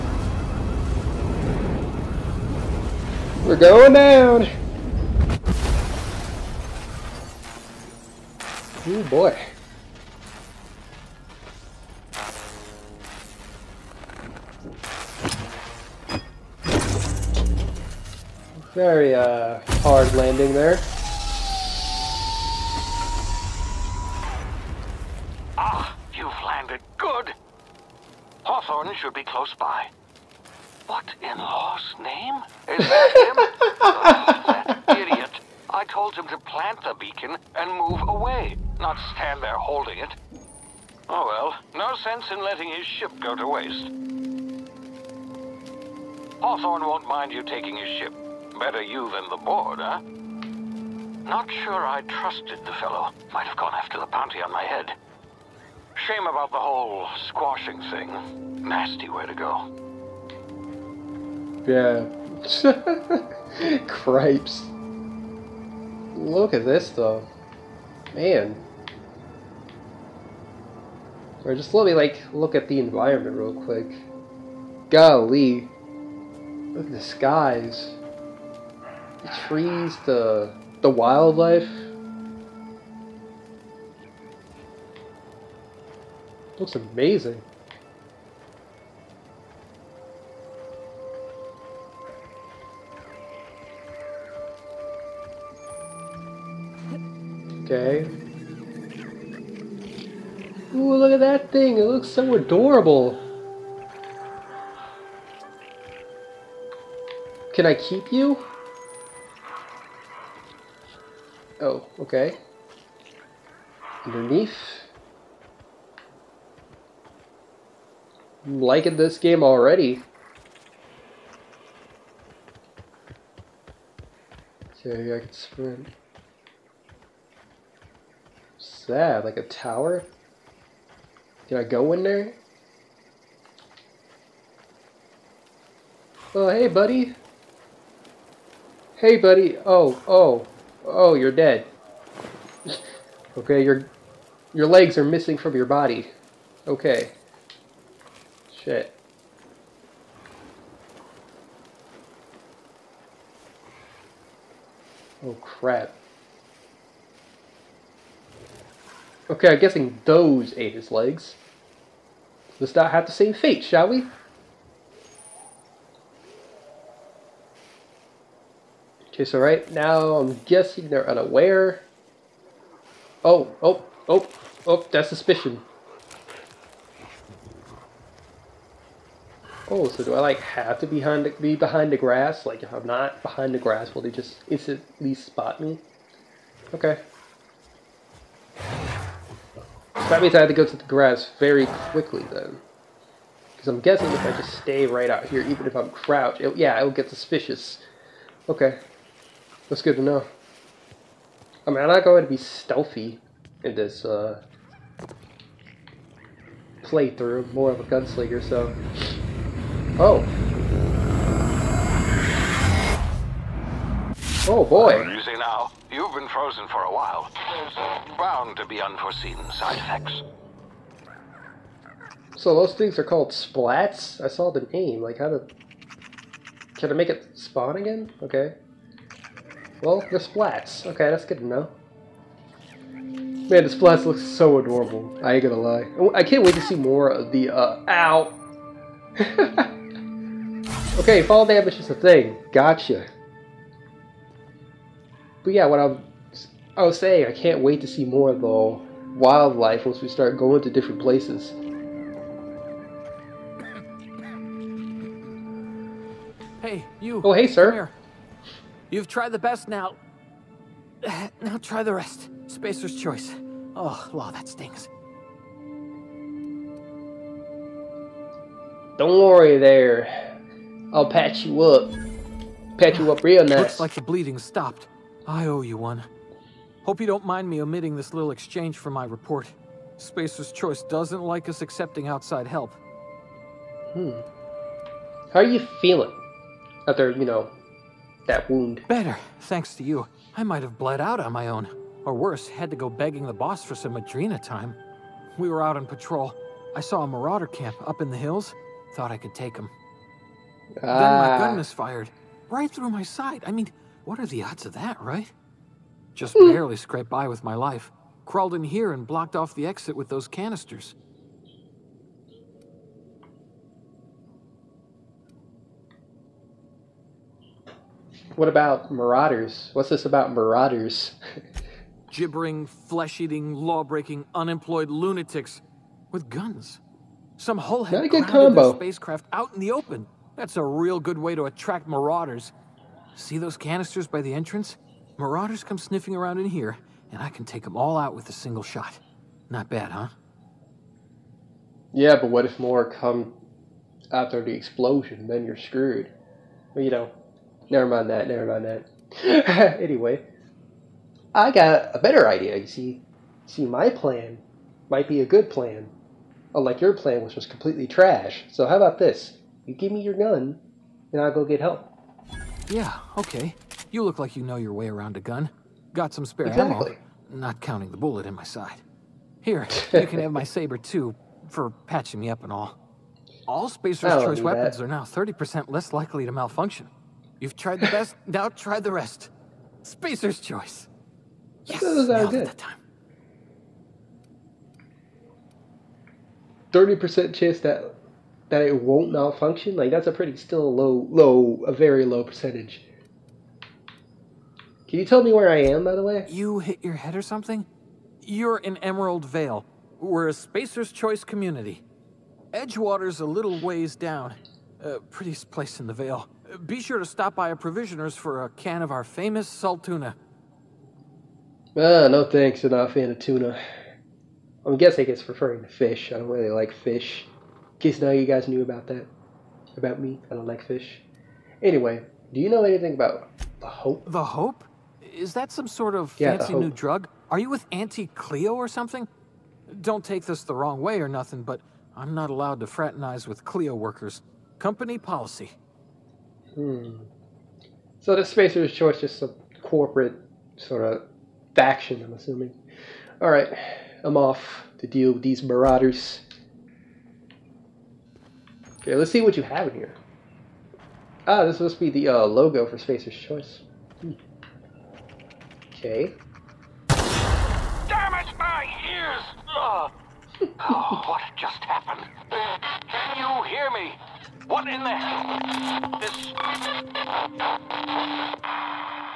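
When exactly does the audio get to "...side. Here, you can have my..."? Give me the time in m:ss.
6:08.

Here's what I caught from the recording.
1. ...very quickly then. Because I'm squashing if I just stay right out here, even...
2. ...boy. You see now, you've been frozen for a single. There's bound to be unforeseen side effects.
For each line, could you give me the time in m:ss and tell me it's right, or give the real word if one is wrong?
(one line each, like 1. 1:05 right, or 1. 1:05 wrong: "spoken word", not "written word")
1. 3:11 wrong: "guessing", not "squashing"
2. 3:34 wrong: "while", not "single".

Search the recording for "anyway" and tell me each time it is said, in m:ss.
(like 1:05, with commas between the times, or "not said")
5:49, 7:01.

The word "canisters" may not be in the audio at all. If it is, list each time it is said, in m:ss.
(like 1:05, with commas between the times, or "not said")
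5:10, 5:33.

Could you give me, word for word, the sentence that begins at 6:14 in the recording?
are now 30% less likely to malfunction.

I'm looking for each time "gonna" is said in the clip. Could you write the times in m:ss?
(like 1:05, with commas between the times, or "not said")
3:55.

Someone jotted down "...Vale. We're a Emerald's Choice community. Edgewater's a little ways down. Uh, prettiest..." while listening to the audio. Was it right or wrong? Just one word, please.
wrong.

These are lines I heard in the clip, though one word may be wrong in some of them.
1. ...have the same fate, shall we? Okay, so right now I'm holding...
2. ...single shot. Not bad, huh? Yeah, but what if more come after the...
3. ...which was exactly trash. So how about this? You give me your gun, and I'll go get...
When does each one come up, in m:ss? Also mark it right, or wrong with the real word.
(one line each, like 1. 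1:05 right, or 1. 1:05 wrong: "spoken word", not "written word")
1. 2:42 wrong: "guessing", not "holding"
2. 5:38 right
3. 5:57 wrong: "completely", not "exactly".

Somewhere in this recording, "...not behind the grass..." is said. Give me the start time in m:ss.
3:02.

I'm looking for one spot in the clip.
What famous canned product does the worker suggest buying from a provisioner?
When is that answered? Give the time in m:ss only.
6:49.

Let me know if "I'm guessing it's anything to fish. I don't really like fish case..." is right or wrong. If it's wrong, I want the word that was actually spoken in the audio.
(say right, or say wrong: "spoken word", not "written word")
wrong: "referring", not "anything".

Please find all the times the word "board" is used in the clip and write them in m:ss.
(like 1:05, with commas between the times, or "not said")
0:49.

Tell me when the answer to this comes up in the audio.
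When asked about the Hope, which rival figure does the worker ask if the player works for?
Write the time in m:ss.
7:07.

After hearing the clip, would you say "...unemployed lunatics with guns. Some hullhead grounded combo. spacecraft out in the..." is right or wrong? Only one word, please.
right.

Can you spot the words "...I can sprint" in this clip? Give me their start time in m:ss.
2:05.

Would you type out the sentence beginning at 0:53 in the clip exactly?
Might have gone after the bounty on my head.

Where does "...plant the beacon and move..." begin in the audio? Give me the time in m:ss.
0:36.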